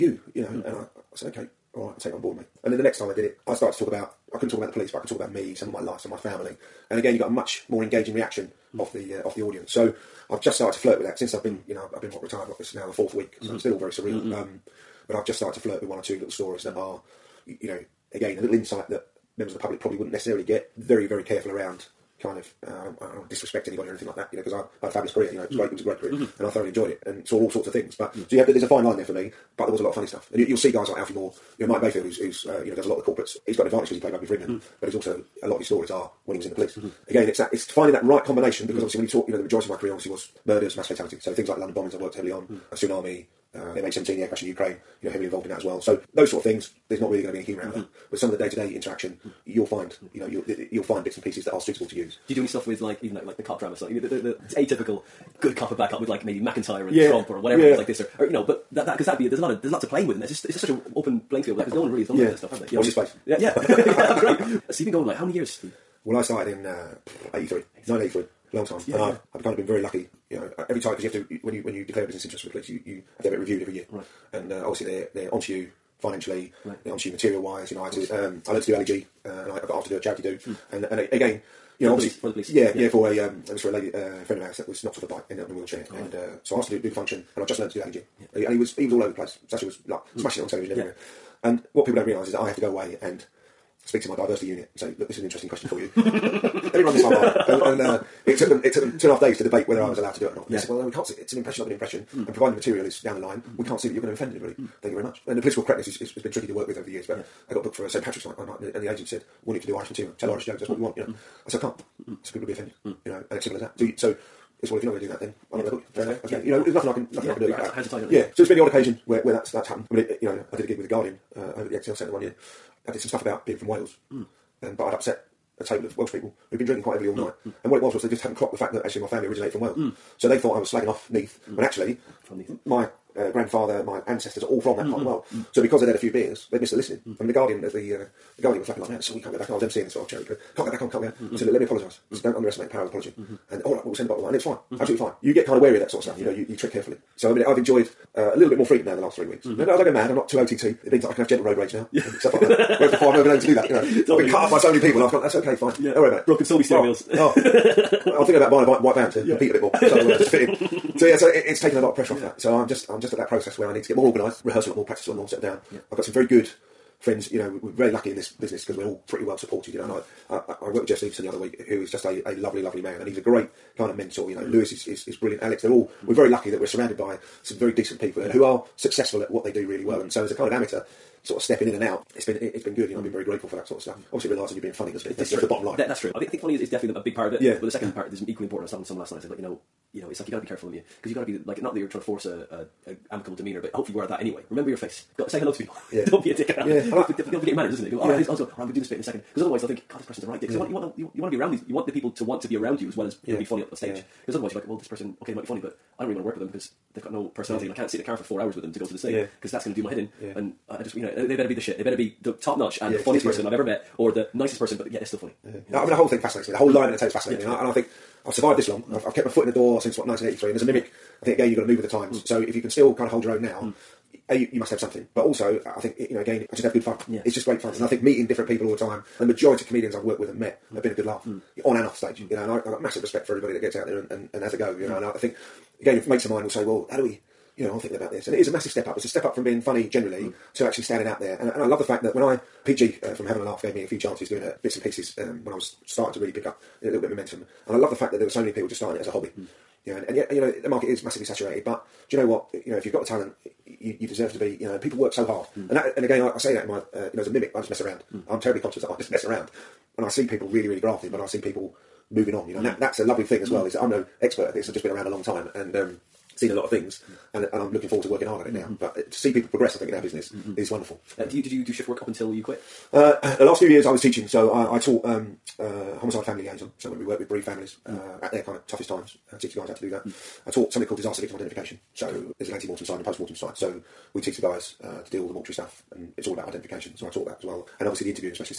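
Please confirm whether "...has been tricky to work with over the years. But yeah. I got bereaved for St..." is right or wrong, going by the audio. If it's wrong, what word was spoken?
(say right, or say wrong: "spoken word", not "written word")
wrong: "booked", not "bereaved".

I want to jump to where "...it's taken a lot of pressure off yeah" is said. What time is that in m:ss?
2:41.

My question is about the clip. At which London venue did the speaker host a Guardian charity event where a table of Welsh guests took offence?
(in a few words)
ExCeL Centre.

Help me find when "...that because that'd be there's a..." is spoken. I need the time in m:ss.
0:58.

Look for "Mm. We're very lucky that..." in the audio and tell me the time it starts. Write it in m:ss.
2:56.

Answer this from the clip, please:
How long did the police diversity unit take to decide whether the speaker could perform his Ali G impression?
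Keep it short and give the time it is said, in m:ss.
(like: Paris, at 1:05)
two and a half days, at 1:38.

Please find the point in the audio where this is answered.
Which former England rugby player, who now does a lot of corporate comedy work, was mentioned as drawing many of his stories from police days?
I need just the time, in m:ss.
0:31.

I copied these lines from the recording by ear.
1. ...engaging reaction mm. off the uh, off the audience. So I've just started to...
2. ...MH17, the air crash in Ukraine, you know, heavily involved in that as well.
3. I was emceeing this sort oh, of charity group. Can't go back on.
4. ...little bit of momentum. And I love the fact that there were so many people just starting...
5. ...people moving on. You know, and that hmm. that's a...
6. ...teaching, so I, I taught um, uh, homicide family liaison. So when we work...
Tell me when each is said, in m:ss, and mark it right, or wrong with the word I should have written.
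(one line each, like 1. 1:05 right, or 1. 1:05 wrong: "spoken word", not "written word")
1. 0:07 right
2. 0:43 right
3. 2:19 right
4. 4:06 right
5. 4:21 right
6. 4:34 right.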